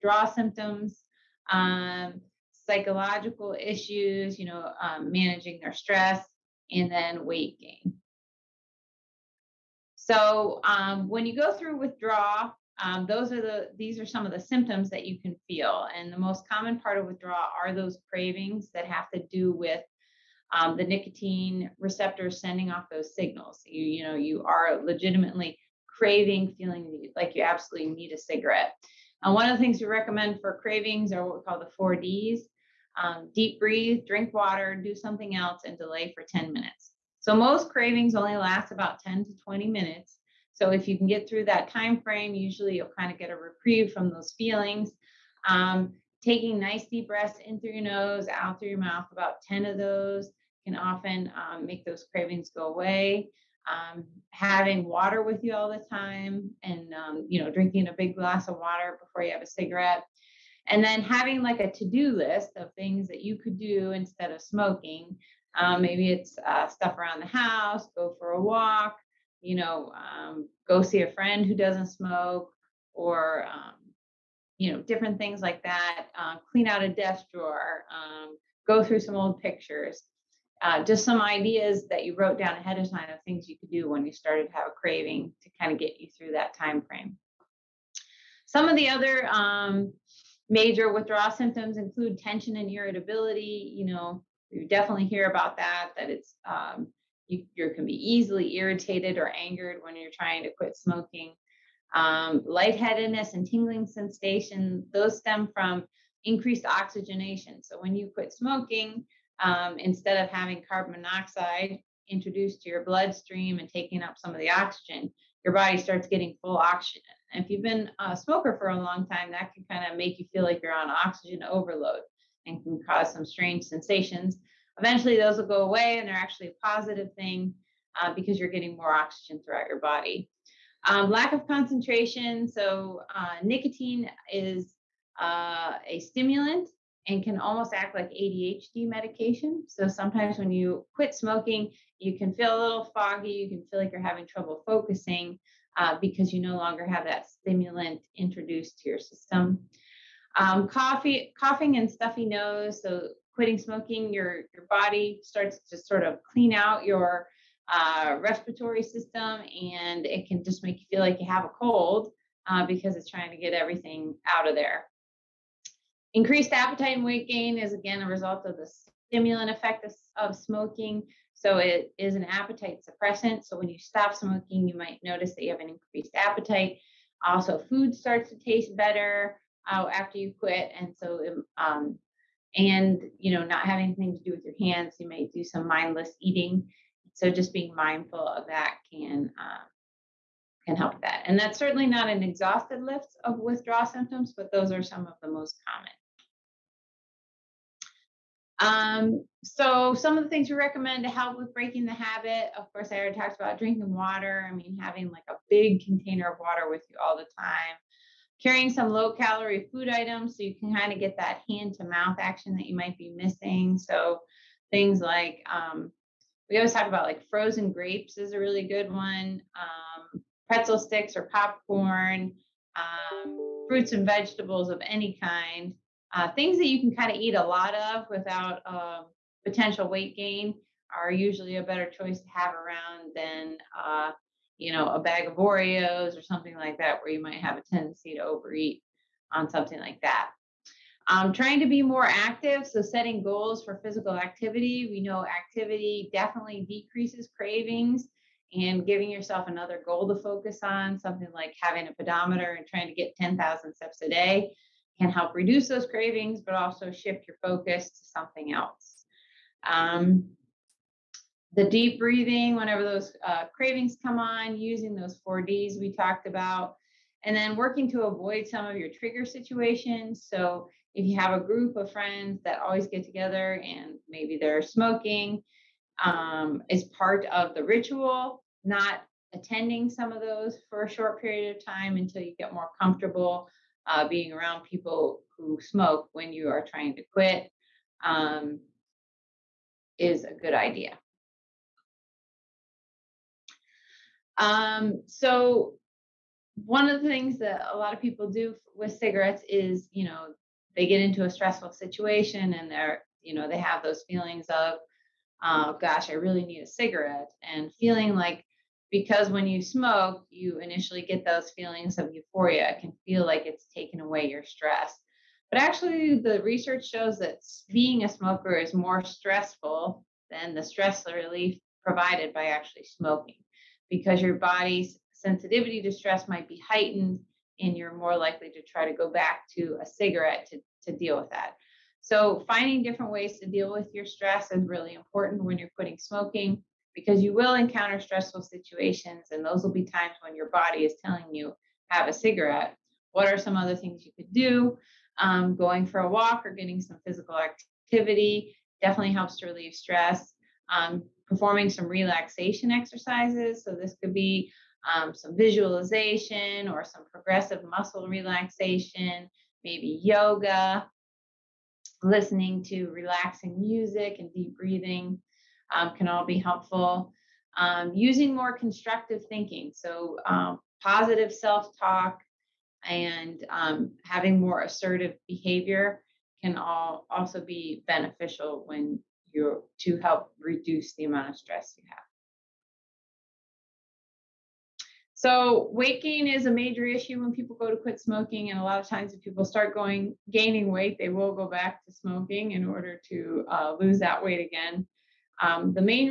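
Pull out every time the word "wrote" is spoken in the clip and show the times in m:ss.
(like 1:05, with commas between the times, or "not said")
1:22.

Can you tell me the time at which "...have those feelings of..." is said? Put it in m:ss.
5:03.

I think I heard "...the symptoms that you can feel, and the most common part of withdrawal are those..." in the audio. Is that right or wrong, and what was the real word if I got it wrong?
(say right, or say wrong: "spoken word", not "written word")
right.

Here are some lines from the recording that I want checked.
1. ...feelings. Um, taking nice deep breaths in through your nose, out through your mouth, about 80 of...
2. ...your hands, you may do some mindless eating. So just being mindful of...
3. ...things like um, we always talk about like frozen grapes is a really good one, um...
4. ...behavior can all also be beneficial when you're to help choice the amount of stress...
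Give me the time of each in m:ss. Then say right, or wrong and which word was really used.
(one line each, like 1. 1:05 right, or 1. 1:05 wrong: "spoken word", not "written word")
1. 0:44 wrong: "10", not "80"
2. 3:04 right
3. 3:34 right
4. 6:15 wrong: "reduce", not "choice".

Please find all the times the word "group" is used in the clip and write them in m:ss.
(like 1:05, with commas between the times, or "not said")
4:31.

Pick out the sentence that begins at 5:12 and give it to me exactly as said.
It can feel like it's taken away your stress.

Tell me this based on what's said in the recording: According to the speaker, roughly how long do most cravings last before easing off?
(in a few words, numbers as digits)
10 to 20 minutes.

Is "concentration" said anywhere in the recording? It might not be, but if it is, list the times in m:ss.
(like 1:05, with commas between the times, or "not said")
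2:11.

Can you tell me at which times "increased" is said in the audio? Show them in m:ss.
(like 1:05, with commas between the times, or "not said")
1:46, 2:46, 2:55.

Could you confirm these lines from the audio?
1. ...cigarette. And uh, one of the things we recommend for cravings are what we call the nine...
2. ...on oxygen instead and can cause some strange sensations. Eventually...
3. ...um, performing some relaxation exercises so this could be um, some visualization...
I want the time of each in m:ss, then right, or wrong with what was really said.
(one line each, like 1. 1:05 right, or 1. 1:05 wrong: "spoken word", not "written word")
1. 0:28 wrong: "four", not "nine"
2. 2:00 wrong: "overload", not "instead"
3. 5:50 right.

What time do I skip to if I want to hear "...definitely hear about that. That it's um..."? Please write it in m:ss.
1:34.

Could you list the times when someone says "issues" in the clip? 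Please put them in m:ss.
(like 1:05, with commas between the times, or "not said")
0:03, 6:26.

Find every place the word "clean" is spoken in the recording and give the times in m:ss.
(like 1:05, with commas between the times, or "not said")
1:16, 2:36.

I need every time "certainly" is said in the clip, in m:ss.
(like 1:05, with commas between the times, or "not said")
3:11.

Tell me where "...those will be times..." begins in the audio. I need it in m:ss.
5:39.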